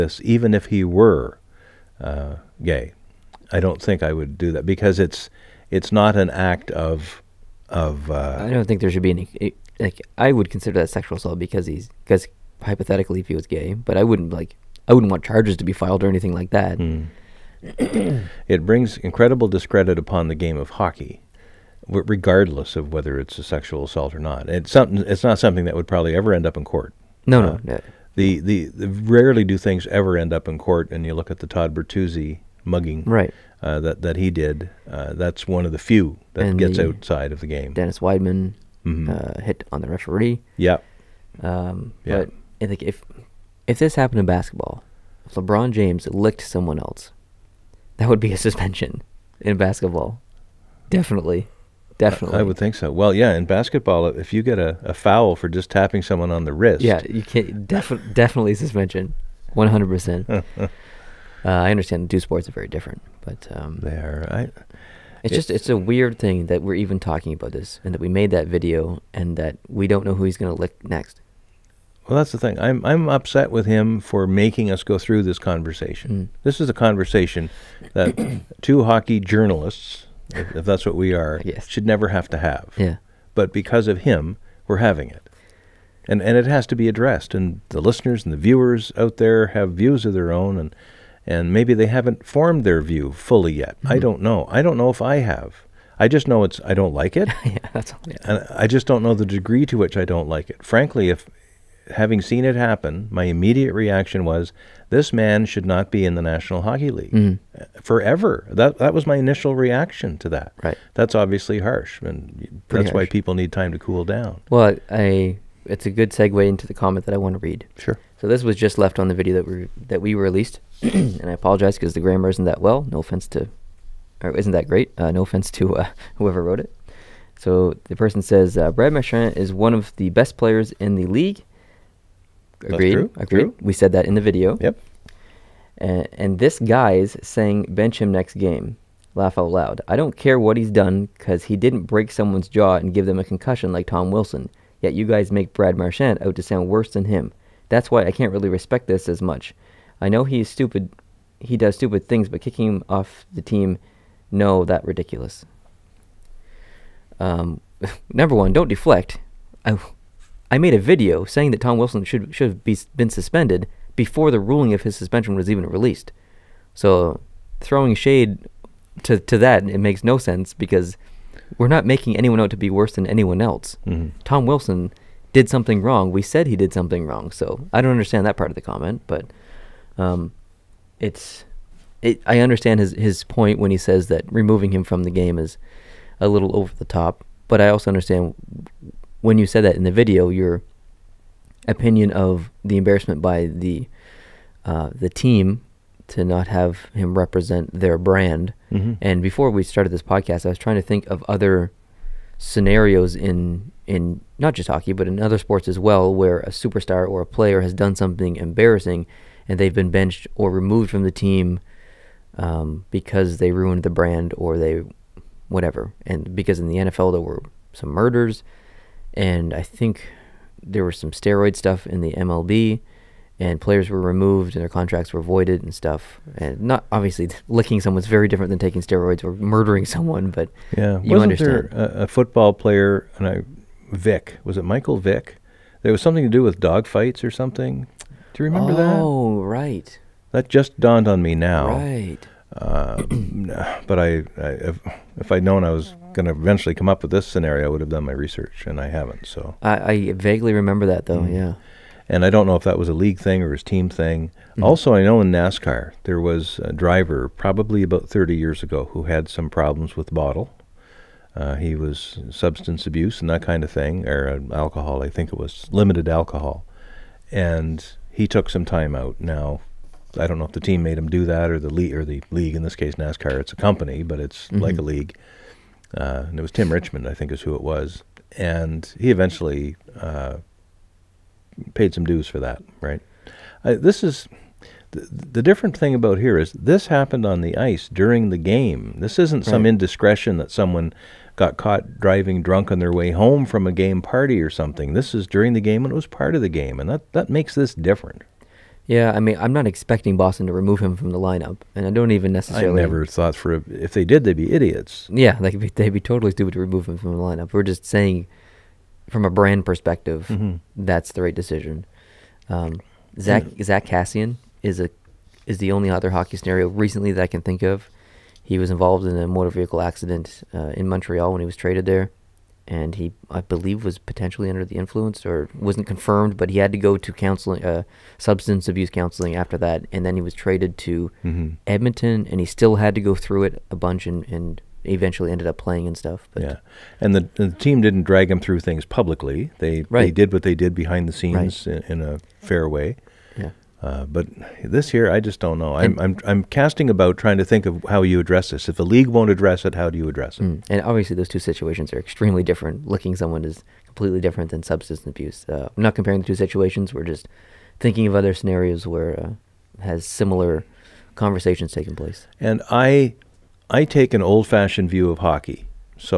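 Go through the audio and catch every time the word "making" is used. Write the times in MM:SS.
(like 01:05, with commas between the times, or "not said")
01:14, 02:51.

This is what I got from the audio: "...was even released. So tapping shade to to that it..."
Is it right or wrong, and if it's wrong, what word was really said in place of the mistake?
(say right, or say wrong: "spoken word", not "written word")
wrong: "throwing", not "tapping".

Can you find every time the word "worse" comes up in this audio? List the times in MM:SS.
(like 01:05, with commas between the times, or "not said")
02:26, 02:52.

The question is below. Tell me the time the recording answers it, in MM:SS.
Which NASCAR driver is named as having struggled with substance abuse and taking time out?
04:36.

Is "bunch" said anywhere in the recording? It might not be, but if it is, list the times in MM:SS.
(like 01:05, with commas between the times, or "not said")
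05:33.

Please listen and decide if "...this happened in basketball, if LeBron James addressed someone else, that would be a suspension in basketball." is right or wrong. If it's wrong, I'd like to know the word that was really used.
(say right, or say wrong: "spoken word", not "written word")
wrong: "licked", not "addressed".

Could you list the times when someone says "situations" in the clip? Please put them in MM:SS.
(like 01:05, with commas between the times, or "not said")
05:51, 05:56.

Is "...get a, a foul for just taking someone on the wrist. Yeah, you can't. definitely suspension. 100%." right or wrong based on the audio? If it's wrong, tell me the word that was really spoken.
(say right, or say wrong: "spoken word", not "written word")
wrong: "tapping", not "taking".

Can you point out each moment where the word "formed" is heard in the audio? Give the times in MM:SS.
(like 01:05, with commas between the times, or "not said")
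01:32.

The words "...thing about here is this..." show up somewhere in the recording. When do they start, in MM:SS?
04:45.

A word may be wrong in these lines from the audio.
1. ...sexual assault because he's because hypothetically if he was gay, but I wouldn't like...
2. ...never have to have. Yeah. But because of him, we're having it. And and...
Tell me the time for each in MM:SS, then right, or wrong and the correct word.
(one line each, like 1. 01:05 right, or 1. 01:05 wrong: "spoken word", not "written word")
1. 00:10 right
2. 01:21 right.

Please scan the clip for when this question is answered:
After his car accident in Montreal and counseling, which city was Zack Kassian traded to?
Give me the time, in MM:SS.
05:31.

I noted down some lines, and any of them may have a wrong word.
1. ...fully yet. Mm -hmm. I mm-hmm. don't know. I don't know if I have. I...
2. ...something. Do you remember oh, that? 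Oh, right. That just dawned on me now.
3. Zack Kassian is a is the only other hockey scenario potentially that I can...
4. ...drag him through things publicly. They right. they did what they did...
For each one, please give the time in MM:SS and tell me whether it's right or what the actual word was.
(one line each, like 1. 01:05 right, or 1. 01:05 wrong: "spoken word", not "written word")
1. 01:33 right
2. 03:57 right
3. 05:13 wrong: "recently", not "potentially"
4. 05:38 right.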